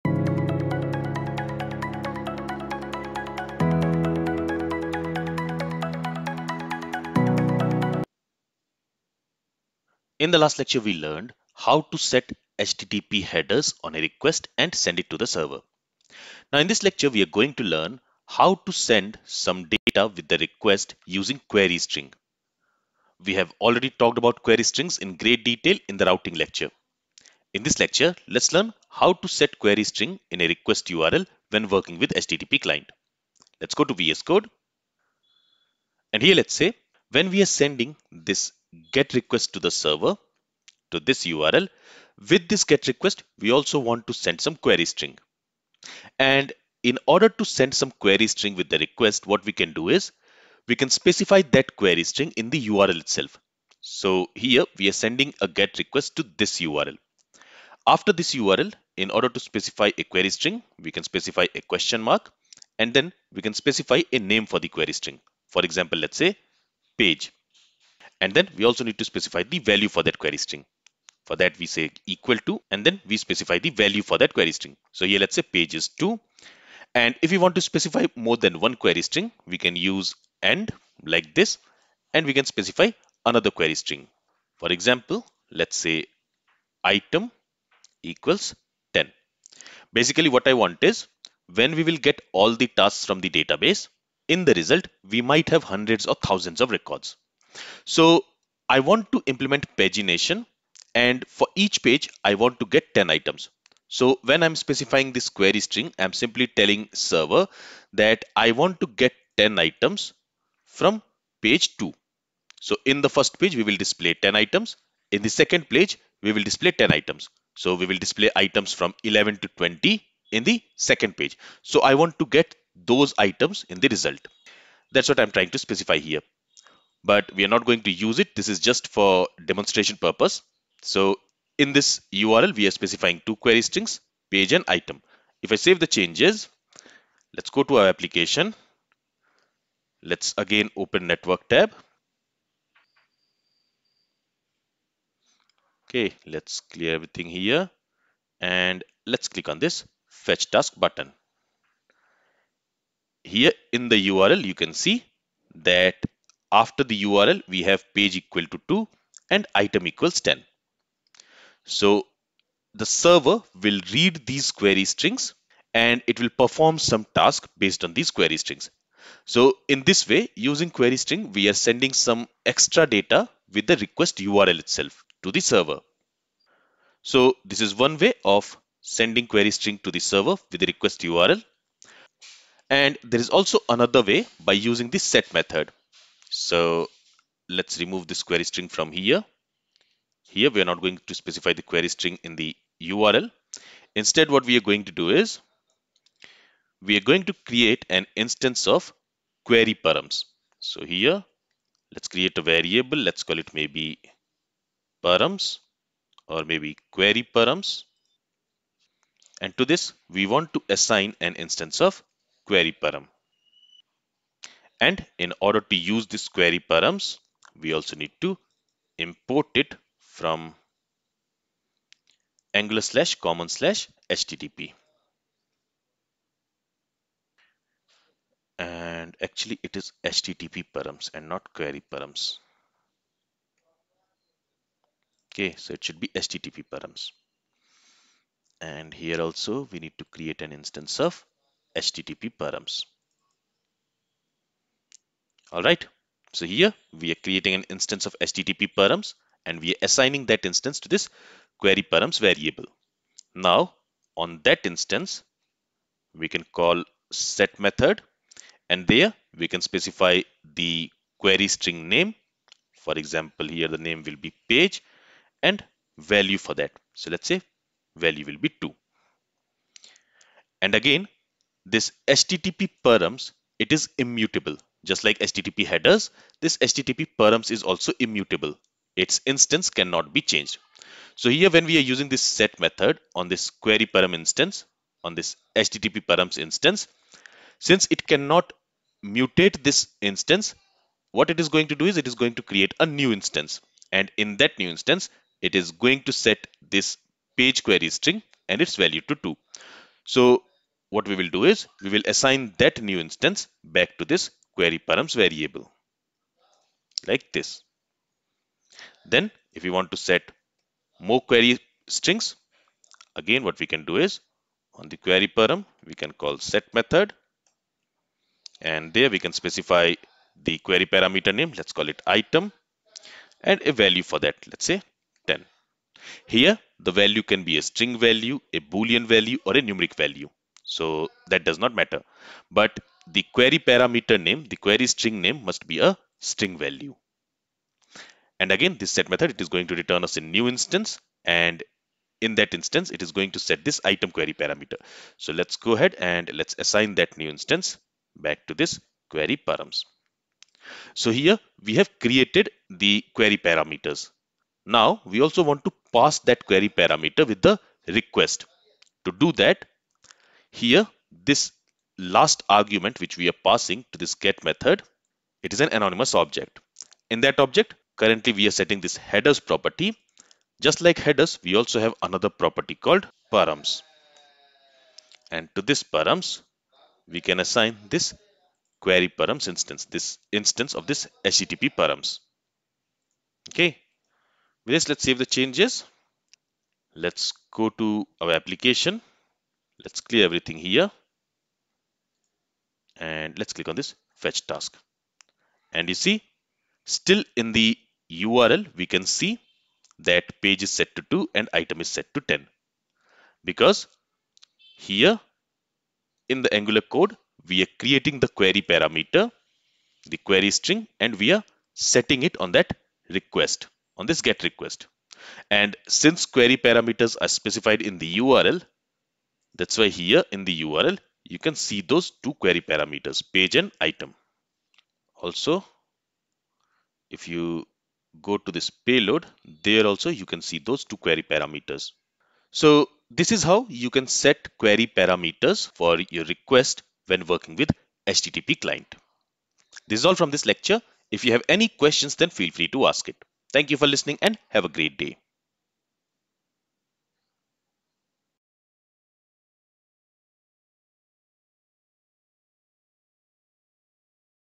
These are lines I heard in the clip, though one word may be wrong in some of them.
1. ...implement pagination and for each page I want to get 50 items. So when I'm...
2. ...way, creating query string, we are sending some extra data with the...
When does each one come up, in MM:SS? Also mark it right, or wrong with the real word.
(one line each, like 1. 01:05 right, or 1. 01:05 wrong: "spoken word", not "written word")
1. 01:39 wrong: "10", not "50"
2. 02:50 wrong: "using", not "creating".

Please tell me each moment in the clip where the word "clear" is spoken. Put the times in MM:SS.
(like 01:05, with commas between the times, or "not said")
02:26, 06:30.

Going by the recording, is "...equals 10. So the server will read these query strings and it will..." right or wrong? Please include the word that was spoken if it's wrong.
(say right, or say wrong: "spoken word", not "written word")
right.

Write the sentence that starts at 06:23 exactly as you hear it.
Okay, with this, let's save the changes.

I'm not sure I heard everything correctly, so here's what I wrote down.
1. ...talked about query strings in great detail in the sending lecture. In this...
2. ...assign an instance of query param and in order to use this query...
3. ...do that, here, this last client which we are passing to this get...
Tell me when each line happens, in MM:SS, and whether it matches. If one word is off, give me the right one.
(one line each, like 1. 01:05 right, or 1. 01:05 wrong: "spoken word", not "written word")
1. 00:23 wrong: "routing", not "sending"
2. 03:30 right
3. 05:59 wrong: "argument", not "client".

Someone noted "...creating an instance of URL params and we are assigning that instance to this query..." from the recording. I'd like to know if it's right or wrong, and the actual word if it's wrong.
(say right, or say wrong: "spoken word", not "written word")
wrong: "HTTP", not "URL".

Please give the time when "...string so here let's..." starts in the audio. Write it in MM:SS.
01:14.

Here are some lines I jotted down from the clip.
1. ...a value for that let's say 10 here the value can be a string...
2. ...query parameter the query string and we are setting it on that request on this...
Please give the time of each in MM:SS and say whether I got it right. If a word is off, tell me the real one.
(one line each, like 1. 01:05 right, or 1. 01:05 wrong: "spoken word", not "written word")
1. 05:23 right
2. 06:48 right.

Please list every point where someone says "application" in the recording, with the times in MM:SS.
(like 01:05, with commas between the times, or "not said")
02:17, 06:28.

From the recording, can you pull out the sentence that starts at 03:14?
Instead, what we are going to do is we are going to create an instance of query params.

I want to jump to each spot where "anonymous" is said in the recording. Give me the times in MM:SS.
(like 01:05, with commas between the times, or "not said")
06:05.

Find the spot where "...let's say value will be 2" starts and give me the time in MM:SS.
04:27.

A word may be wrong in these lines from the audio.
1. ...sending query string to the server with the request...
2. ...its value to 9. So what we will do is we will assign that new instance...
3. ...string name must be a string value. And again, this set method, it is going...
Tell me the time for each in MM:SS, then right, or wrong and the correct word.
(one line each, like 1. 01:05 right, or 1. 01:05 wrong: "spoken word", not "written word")
1. 02:58 right
2. 04:58 wrong: "2", not "9"
3. 05:34 right.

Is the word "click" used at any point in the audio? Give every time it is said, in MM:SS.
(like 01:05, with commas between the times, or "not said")
02:29, 06:33.